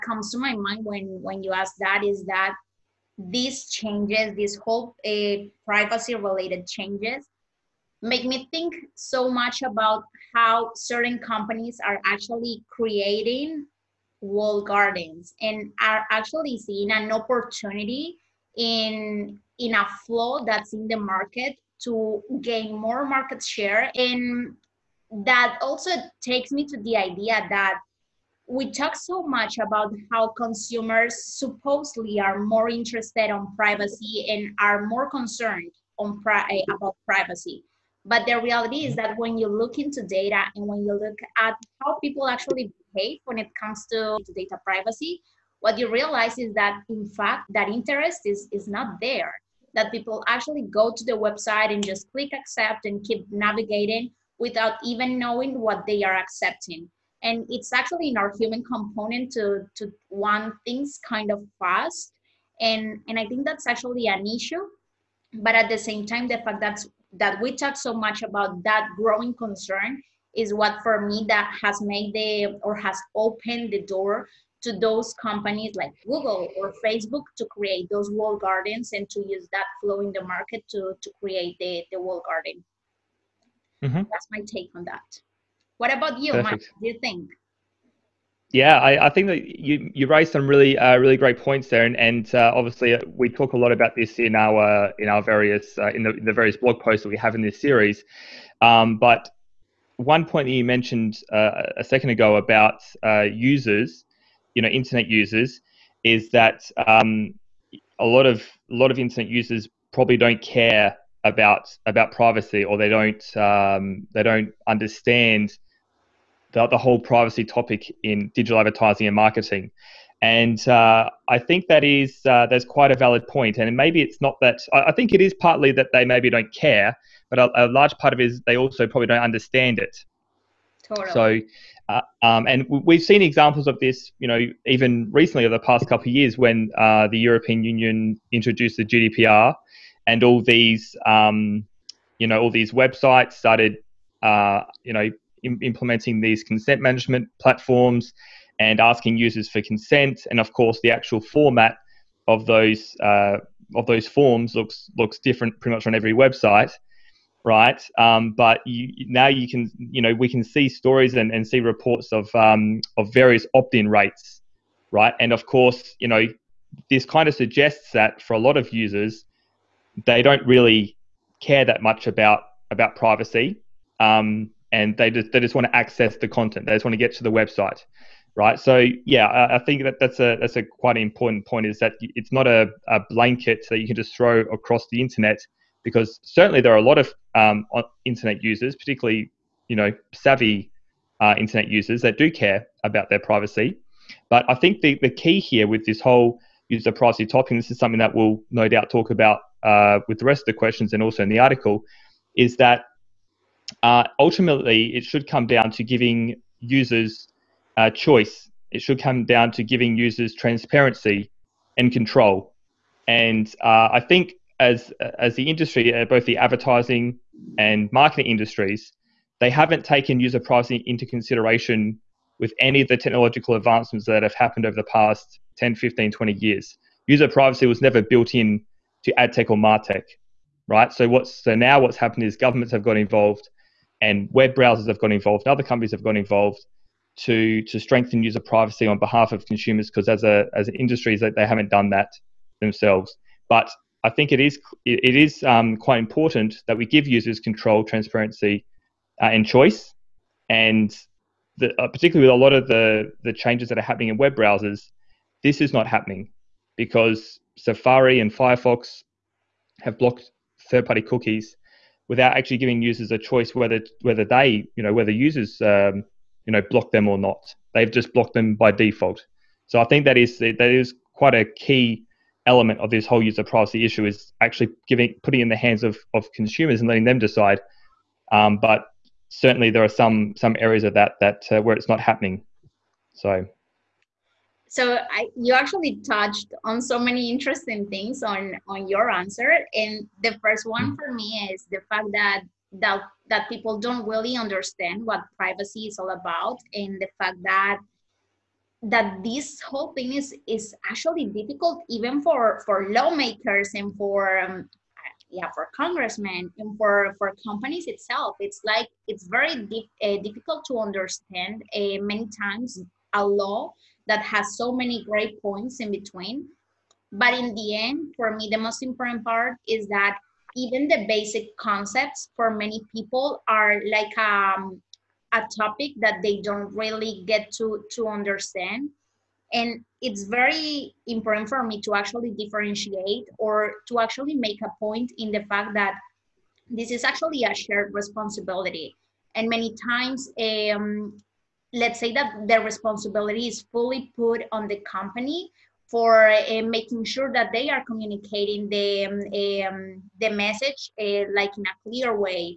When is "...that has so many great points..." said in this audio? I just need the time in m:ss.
5:14.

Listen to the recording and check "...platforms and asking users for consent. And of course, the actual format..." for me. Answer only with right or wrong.
right.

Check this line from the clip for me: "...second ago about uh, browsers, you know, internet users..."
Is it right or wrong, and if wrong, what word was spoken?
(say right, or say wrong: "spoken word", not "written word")
wrong: "users", not "browsers".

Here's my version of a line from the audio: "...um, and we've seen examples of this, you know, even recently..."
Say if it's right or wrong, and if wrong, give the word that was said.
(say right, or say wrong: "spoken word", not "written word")
right.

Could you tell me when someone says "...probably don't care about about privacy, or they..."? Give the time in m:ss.
1:49.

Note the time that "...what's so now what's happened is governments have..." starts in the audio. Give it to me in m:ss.
3:51.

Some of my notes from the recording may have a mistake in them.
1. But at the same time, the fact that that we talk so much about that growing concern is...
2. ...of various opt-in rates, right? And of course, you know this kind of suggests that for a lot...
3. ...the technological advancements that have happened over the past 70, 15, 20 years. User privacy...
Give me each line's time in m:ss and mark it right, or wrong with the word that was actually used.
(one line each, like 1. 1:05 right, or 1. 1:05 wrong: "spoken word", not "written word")
1. 1:05 right
2. 2:42 right
3. 3:42 wrong: "10", not "70".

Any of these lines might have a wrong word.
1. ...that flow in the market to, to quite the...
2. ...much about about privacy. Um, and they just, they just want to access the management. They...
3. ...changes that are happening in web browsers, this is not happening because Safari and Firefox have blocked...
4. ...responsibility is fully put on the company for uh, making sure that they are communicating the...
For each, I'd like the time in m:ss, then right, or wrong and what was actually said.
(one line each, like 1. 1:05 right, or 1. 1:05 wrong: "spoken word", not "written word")
1. 1:19 wrong: "create", not "quite"
2. 2:51 wrong: "content", not "management"
3. 4:13 right
4. 5:42 right.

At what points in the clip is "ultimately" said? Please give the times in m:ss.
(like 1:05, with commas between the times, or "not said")
3:24.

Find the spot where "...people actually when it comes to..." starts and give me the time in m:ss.
0:41.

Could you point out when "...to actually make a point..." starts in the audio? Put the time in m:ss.
5:33.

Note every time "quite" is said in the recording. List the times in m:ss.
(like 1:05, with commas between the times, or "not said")
2:02, 3:00, 4:05, 4:31.